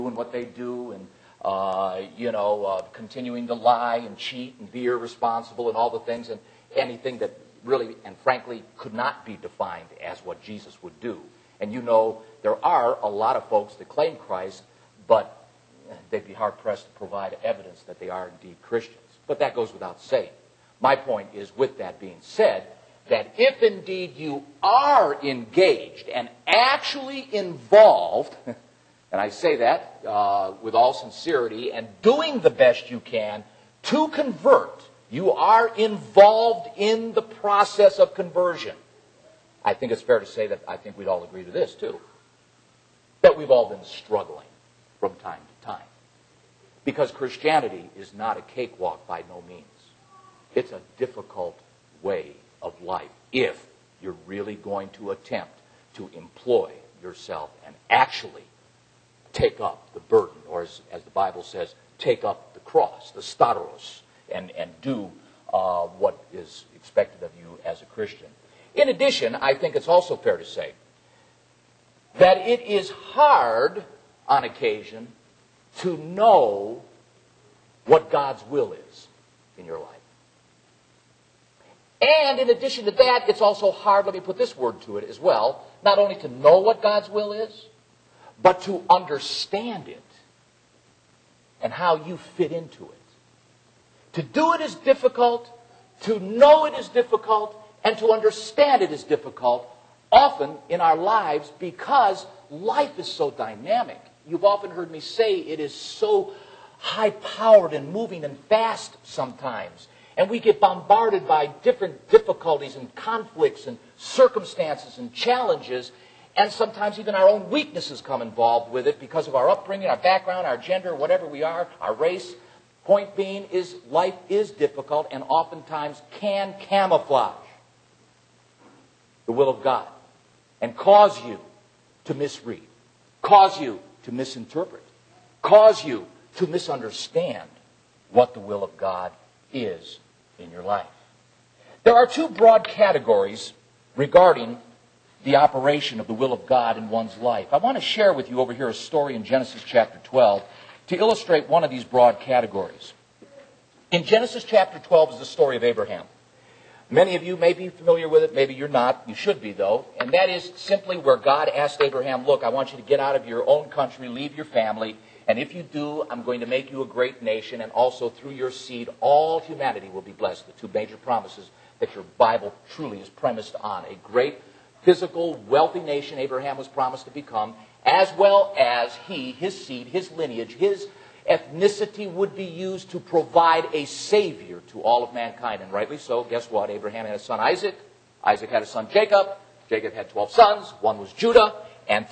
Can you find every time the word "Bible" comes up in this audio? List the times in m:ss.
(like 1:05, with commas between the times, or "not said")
1:01, 2:52.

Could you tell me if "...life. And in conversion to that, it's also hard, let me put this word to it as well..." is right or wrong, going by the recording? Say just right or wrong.
wrong.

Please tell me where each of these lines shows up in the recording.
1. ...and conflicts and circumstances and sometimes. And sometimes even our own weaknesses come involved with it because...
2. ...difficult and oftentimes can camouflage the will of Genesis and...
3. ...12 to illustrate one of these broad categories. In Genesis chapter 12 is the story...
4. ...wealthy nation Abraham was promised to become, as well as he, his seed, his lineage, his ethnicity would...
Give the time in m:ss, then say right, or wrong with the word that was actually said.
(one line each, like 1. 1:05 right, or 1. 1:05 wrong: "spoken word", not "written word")
1. 1:52 wrong: "challenges", not "sometimes"
2. 2:04 wrong: "God", not "Genesis"
3. 2:30 right
4. 2:55 right.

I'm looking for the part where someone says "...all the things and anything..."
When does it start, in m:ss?
0:05.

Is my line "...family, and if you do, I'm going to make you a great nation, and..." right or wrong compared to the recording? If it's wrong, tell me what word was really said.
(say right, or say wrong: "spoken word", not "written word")
right.